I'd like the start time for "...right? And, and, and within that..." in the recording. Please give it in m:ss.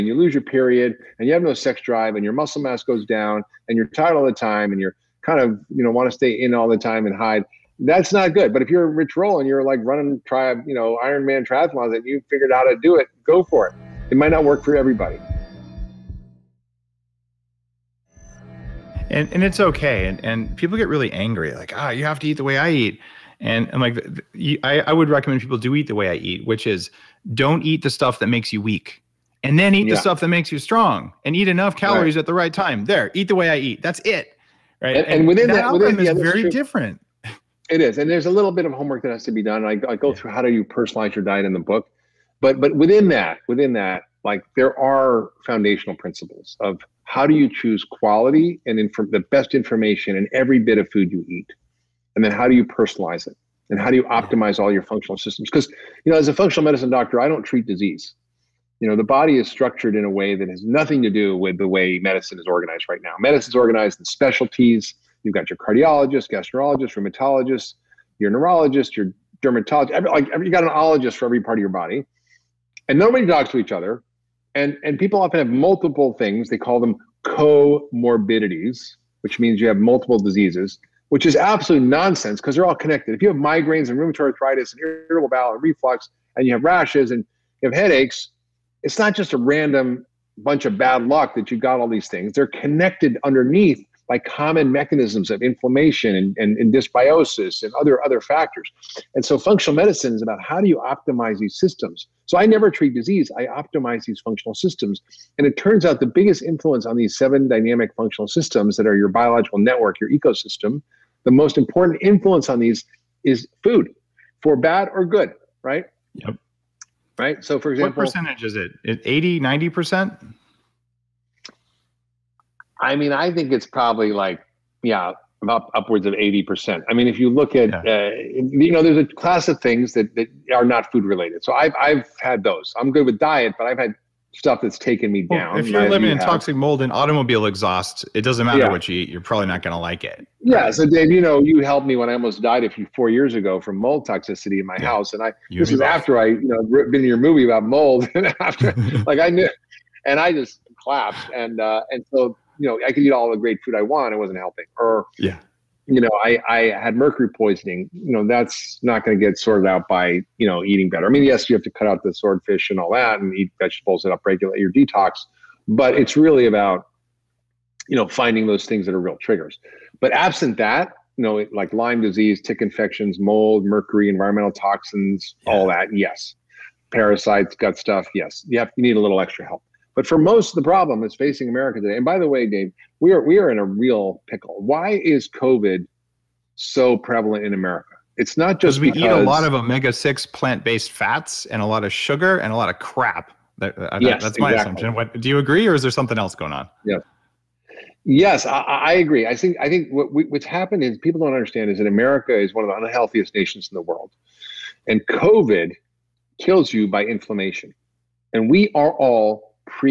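0:34.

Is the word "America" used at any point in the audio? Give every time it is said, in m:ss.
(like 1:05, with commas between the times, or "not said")
3:01, 3:07, 3:21.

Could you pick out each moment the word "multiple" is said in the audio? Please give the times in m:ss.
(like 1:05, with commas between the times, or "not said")
1:15, 1:19.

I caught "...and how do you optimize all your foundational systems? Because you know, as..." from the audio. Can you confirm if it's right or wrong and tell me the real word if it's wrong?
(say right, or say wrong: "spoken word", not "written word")
wrong: "functional", not "foundational".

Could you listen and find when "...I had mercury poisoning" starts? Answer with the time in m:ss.
2:36.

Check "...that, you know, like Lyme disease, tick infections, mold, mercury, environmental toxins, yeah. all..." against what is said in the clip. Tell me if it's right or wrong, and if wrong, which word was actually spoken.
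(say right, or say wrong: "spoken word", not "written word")
right.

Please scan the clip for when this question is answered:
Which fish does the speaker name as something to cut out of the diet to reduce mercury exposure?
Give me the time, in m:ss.
2:42.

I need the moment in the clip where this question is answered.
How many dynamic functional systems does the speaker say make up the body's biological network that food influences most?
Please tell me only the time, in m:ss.
1:47.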